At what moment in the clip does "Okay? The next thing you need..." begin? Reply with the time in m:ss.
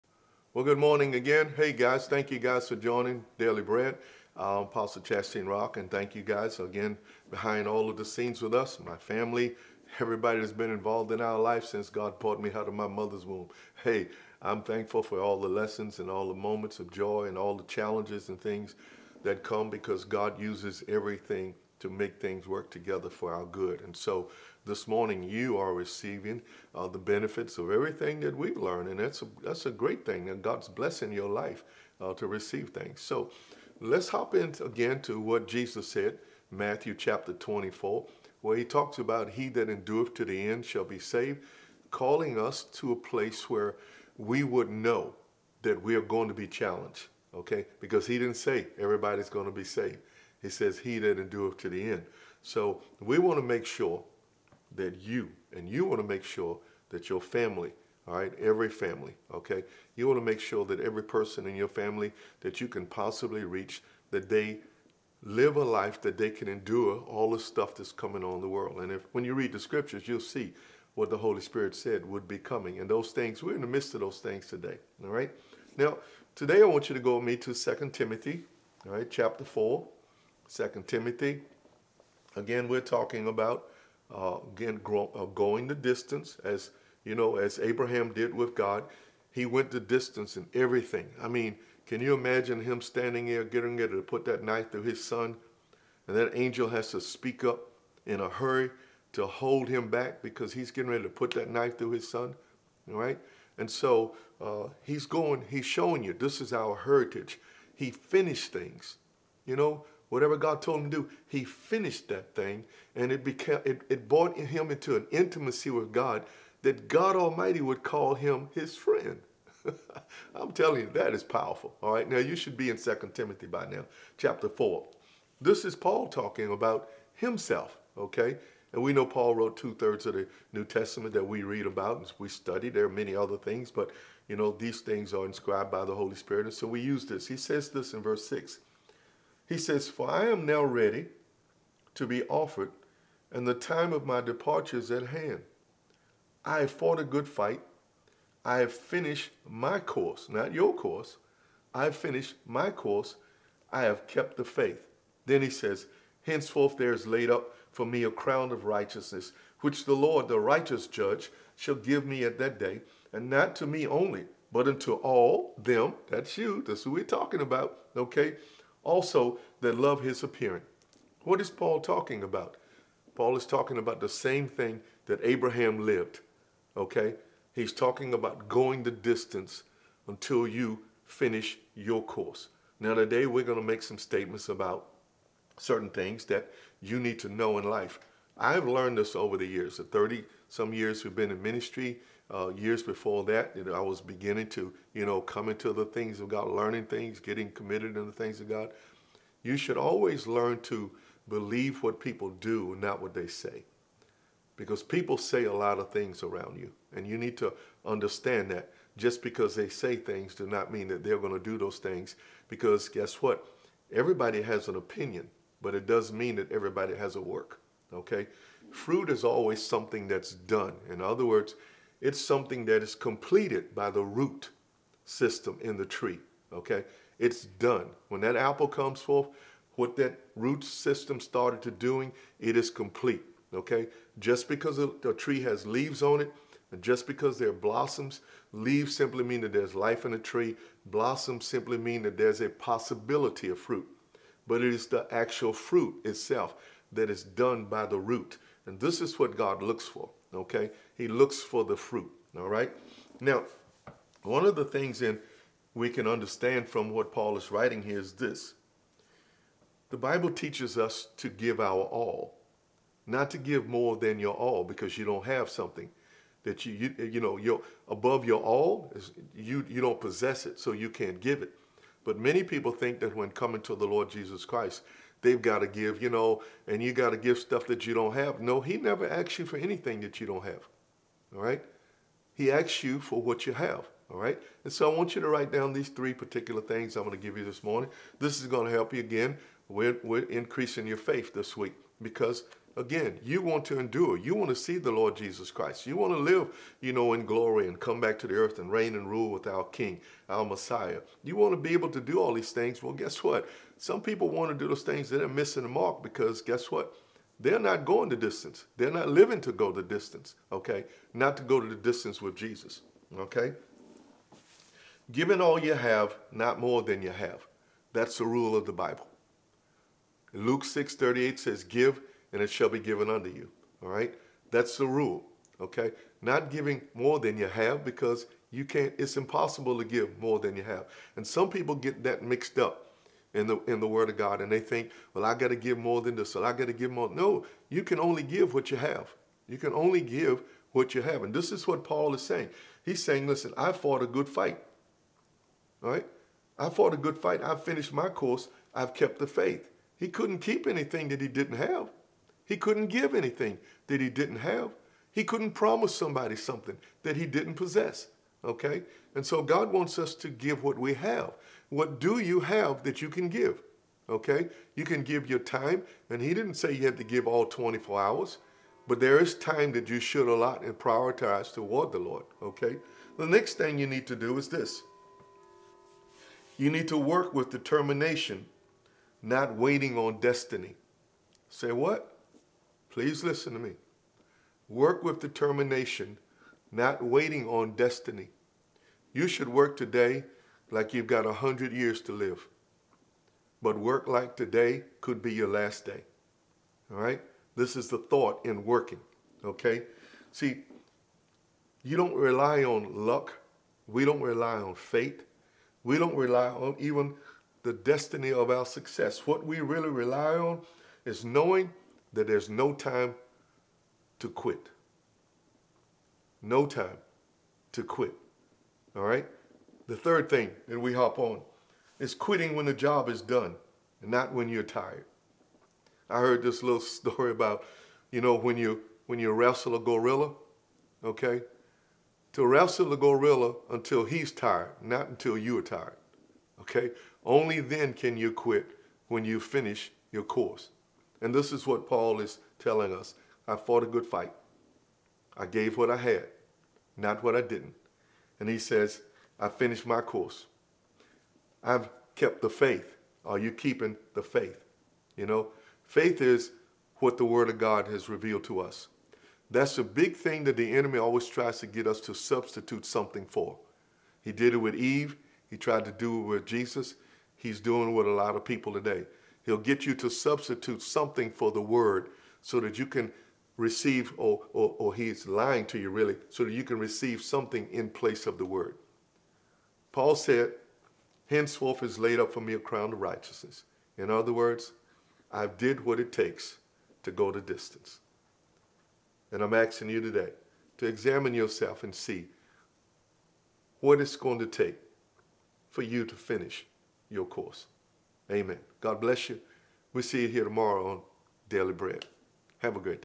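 6:12.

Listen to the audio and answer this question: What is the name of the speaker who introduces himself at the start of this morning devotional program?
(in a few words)
Chastine Rock.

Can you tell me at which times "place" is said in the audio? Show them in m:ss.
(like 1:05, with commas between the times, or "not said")
0:42, 7:57.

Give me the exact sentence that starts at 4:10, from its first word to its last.
He looks for the fruit, all right?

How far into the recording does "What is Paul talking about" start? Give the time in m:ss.
2:51.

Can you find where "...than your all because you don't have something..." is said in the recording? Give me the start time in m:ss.
4:23.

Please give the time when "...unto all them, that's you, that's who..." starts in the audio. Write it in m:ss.
2:44.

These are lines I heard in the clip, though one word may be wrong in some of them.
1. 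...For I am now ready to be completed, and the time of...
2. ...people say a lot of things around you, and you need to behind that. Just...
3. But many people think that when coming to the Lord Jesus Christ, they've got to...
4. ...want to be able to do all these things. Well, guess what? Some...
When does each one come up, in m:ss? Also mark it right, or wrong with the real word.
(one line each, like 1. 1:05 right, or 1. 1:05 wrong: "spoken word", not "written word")
1. 2:19 wrong: "offered", not "completed"
2. 3:24 wrong: "understand", not "behind"
3. 4:32 right
4. 5:01 right.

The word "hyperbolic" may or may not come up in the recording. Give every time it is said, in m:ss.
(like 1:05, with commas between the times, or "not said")
not said.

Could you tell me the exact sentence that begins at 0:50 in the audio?
He says, He that endureth to the end.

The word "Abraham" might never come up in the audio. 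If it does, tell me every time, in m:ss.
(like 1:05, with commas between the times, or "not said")
1:27, 2:55.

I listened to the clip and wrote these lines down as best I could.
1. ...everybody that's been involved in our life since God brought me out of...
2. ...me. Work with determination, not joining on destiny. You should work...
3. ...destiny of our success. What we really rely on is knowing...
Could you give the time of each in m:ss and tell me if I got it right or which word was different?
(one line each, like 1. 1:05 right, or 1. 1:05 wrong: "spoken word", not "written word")
1. 0:10 right
2. 6:23 wrong: "waiting", not "joining"
3. 6:47 right.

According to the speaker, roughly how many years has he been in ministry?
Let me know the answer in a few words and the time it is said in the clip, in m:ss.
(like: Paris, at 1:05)
30 some years, at 3:09.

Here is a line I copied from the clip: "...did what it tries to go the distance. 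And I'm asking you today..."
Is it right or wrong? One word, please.
wrong.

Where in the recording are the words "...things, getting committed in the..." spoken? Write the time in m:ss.
3:16.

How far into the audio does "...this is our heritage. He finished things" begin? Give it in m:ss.
1:46.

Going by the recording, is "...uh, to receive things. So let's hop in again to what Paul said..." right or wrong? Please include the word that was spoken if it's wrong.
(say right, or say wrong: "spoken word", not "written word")
wrong: "Jesus", not "Paul".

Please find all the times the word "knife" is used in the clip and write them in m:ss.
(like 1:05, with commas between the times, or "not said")
1:34, 1:41.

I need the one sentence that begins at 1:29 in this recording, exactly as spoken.
He went the distance in everything.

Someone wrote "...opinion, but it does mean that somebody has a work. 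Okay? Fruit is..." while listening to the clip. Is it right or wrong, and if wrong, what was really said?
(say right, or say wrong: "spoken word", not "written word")
wrong: "everybody", not "somebody".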